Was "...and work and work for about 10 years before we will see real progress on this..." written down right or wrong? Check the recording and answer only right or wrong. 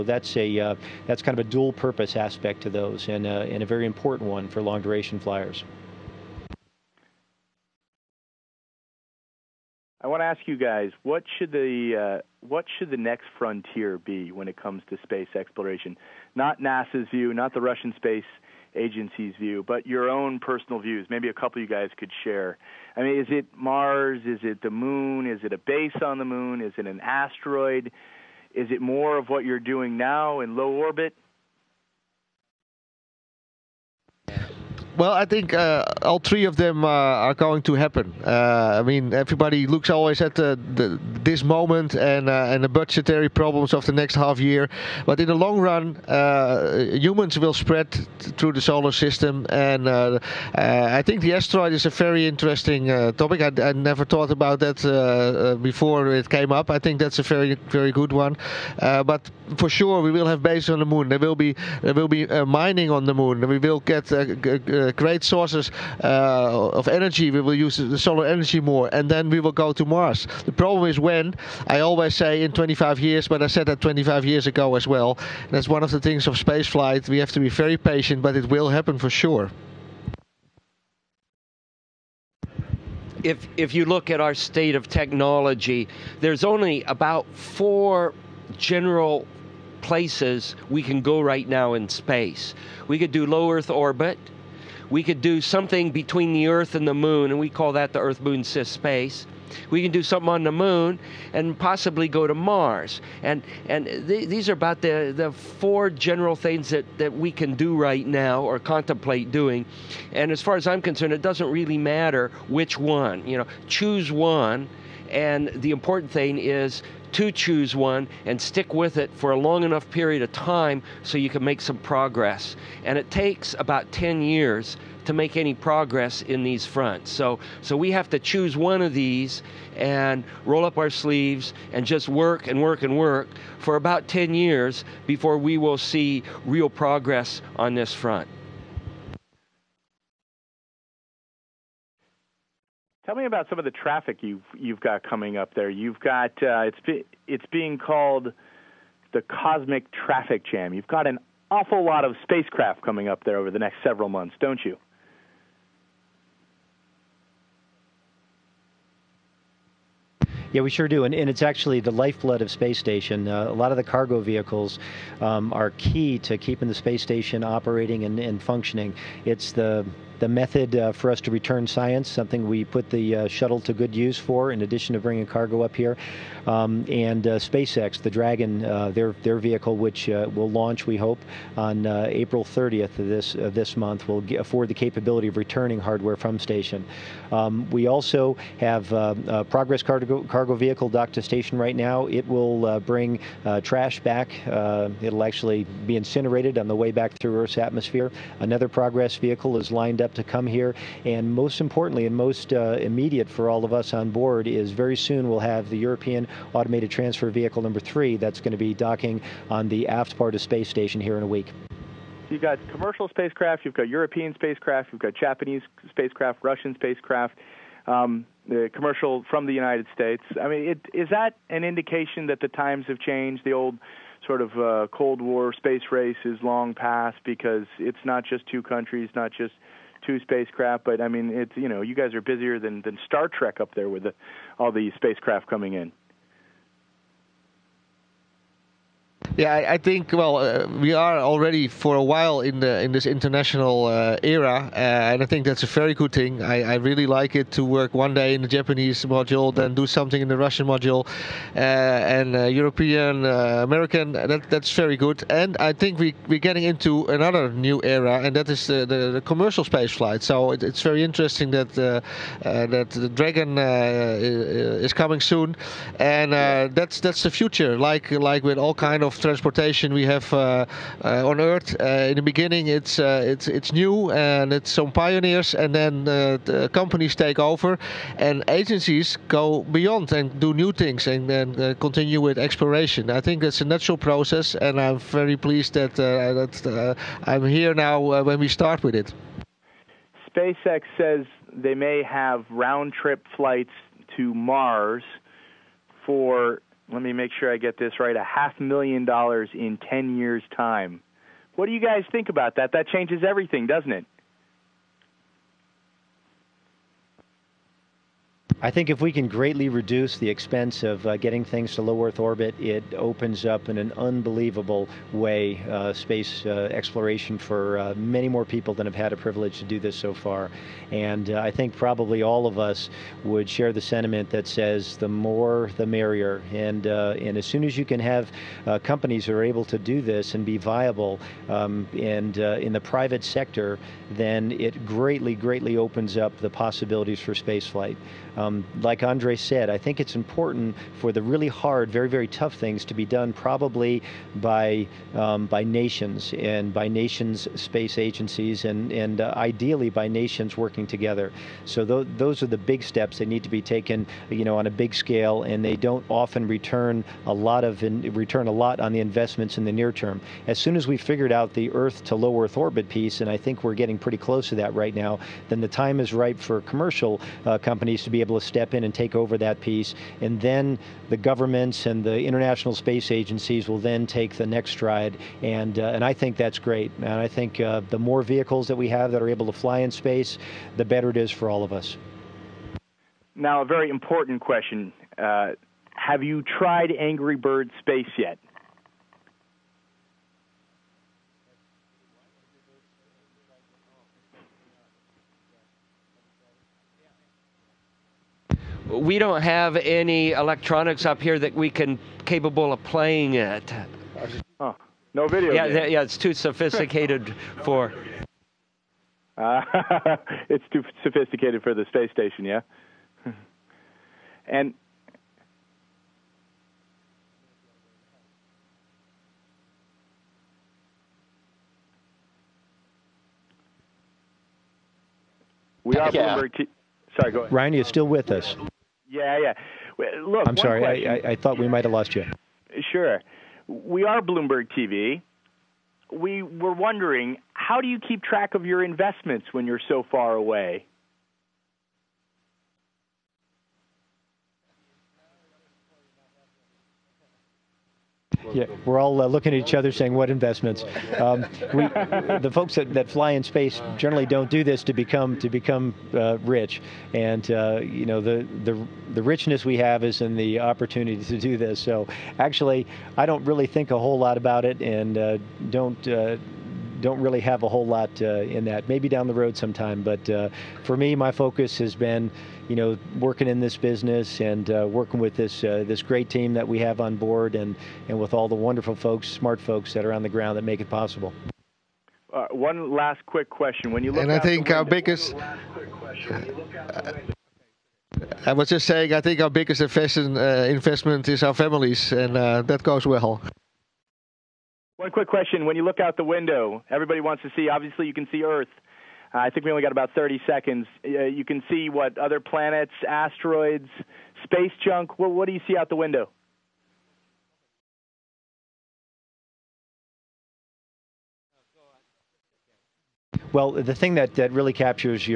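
right.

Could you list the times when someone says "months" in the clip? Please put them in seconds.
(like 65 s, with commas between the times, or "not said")
154 s, 183 s.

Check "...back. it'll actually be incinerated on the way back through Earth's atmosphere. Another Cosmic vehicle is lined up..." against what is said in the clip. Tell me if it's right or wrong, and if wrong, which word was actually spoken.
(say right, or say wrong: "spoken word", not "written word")
wrong: "Progress", not "Cosmic".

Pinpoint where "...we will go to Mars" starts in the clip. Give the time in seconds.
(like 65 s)
69 s.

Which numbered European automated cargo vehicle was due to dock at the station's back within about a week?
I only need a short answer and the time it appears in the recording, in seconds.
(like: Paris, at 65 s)
3, at 207 s.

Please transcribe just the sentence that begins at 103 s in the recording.
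And and th- these are about the, the four general things that, that we can do right now or contemplate doing.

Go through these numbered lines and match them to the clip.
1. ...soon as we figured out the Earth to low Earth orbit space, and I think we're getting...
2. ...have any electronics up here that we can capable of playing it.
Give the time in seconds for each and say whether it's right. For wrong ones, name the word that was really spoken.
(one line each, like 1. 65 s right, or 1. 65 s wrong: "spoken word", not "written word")
1. 360 s wrong: "piece", not "space"
2. 399 s right.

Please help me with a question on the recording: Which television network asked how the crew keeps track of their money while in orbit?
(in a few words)
Bloomberg TV.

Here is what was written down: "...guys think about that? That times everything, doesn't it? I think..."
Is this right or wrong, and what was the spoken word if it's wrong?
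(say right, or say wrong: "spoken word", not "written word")
wrong: "changes", not "times".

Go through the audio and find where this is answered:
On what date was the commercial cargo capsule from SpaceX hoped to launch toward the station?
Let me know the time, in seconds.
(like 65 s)
182 s.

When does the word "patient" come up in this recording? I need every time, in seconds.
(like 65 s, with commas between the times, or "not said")
77 s.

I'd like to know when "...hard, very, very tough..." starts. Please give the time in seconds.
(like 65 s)
341 s.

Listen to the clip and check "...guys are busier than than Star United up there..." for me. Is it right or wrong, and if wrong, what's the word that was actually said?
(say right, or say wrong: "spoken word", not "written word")
wrong: "Trek", not "United".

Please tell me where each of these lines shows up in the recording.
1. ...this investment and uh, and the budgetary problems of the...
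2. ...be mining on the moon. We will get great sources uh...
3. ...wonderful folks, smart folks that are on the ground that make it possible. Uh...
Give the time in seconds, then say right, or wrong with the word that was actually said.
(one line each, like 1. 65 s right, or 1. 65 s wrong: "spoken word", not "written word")
1. 41 s wrong: "moment", not "investment"
2. 62 s right
3. 478 s right.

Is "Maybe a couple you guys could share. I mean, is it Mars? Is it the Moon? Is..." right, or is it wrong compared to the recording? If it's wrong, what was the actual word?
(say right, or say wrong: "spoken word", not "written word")
right.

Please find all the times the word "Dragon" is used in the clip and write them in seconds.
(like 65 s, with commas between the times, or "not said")
178 s, 263 s.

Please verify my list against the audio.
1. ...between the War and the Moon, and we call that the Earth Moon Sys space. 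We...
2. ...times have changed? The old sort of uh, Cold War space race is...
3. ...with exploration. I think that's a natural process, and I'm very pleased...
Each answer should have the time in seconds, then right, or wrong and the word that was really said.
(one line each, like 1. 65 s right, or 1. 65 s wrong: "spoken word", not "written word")
1. 95 s wrong: "Earth", not "War"
2. 222 s right
3. 282 s right.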